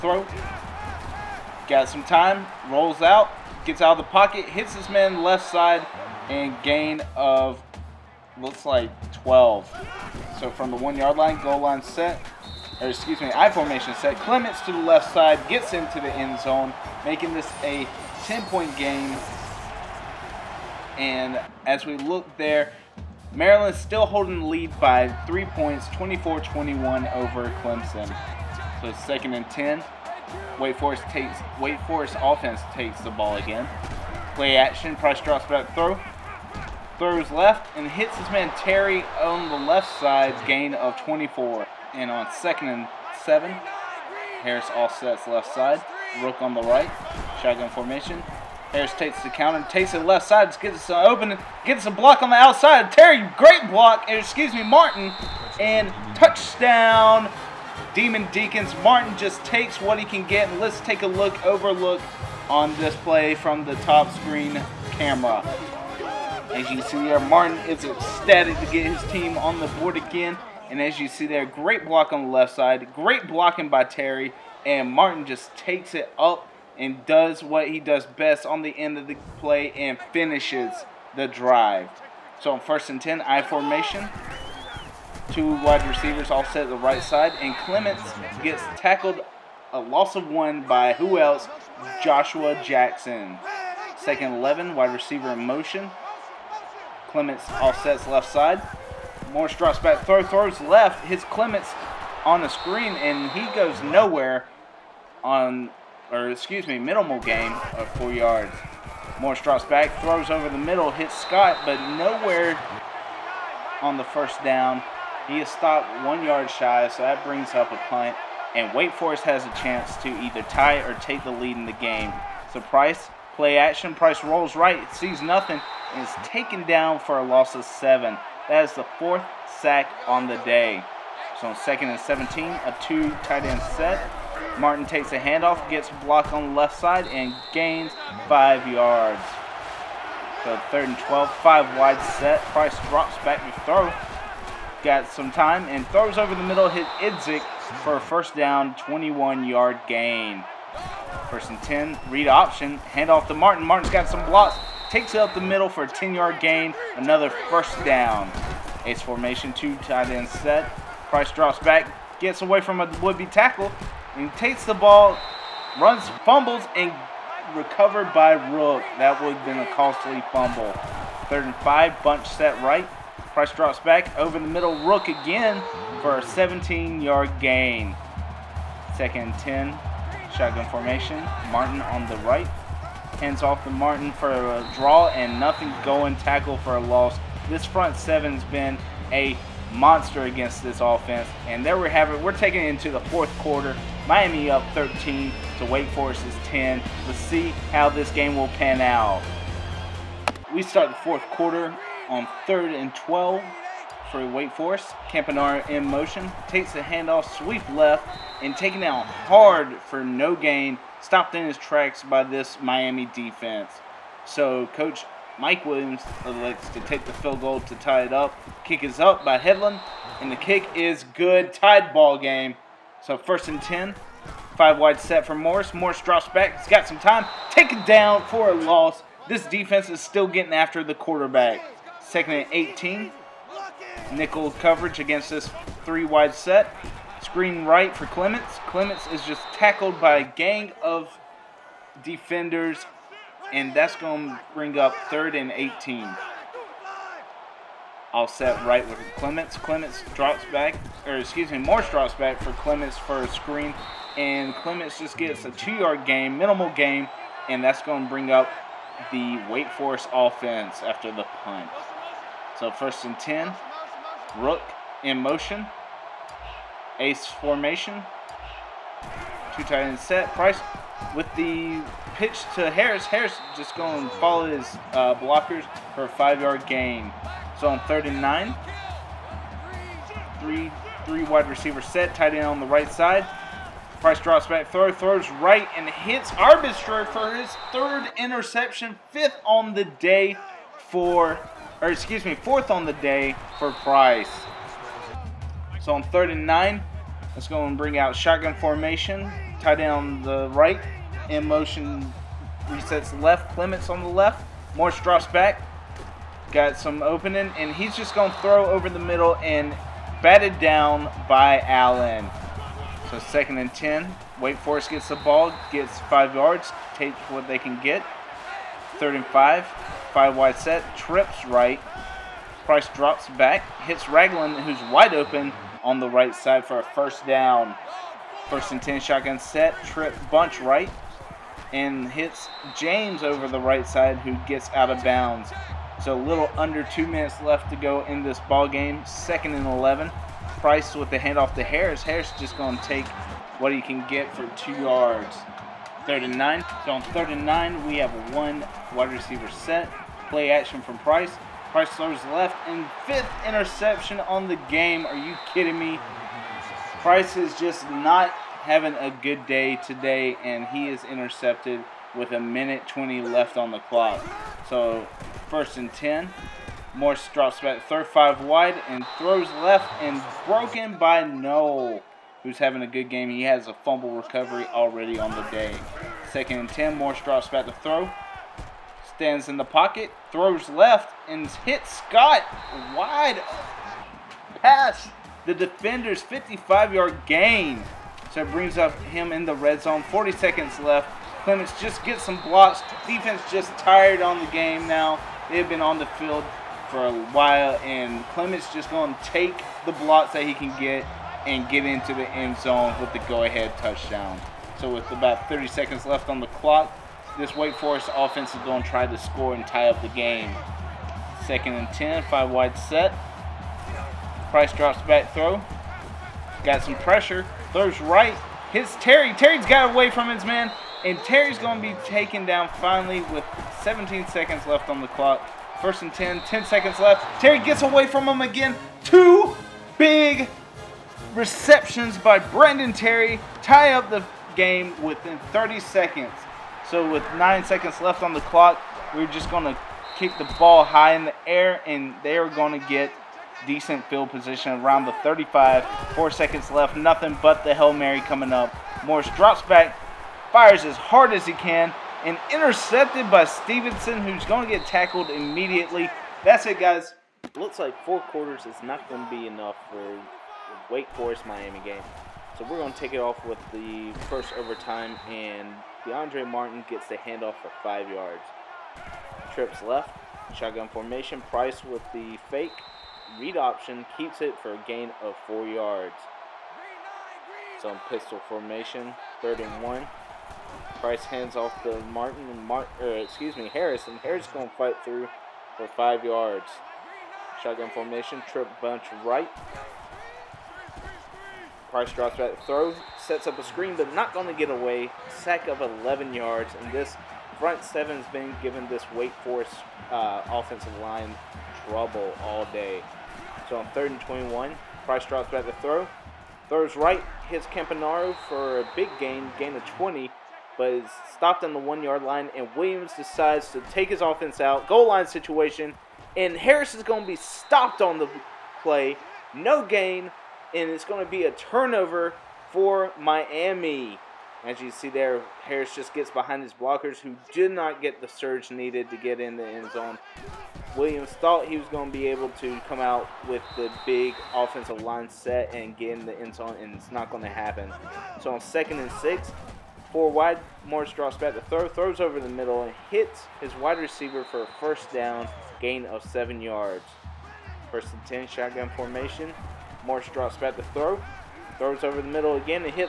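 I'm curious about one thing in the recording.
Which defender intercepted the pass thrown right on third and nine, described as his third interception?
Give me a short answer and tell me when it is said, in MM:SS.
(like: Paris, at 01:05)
Arbitro, at 04:46.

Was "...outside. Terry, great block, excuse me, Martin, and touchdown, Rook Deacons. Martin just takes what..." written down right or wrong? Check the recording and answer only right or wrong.
wrong.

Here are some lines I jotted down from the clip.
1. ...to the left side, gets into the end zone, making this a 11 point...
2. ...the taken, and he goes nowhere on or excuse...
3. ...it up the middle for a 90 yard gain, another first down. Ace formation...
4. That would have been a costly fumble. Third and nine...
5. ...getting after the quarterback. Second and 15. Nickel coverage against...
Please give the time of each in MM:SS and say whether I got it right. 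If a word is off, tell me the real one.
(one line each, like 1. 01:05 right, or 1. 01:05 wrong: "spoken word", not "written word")
1. 00:14 wrong: "10", not "11"
2. 01:42 wrong: "screen", not "taken"
3. 02:35 wrong: "10", not "90"
4. 02:48 wrong: "five", not "nine"
5. 03:50 wrong: "18", not "15".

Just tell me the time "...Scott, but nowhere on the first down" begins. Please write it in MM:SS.
01:51.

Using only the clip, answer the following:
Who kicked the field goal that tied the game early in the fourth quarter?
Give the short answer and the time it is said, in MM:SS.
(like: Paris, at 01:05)
Hedlund, at 03:39.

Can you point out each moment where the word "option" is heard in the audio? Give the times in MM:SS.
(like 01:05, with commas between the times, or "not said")
02:32, 07:53.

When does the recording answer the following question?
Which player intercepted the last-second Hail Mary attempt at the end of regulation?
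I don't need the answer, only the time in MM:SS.
07:33.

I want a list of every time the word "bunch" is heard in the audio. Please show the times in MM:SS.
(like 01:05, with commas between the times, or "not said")
02:52, 05:30, 08:08.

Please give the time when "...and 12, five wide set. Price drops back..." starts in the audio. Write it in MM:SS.
02:20.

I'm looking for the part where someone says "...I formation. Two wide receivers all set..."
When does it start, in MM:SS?
01:23.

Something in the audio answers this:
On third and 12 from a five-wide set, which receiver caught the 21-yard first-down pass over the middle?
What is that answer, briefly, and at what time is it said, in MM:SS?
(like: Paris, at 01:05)
Idzik, at 02:26.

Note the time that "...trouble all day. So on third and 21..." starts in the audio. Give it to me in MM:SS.
08:21.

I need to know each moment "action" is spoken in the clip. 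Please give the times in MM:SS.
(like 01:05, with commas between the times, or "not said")
00:34, 02:03, 05:50.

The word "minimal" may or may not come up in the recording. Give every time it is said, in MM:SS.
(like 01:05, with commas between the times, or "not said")
01:46, 04:16.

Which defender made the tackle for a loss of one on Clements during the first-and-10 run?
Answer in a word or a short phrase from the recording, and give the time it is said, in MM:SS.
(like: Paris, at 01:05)
Joshua Jackson, at 01:32.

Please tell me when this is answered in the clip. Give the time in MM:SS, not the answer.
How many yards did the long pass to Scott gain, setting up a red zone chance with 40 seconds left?
06:26.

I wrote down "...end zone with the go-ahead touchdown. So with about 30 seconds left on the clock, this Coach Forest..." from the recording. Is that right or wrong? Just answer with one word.
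wrong.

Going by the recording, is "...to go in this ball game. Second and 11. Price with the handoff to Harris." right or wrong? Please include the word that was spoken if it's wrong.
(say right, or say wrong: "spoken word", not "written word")
right.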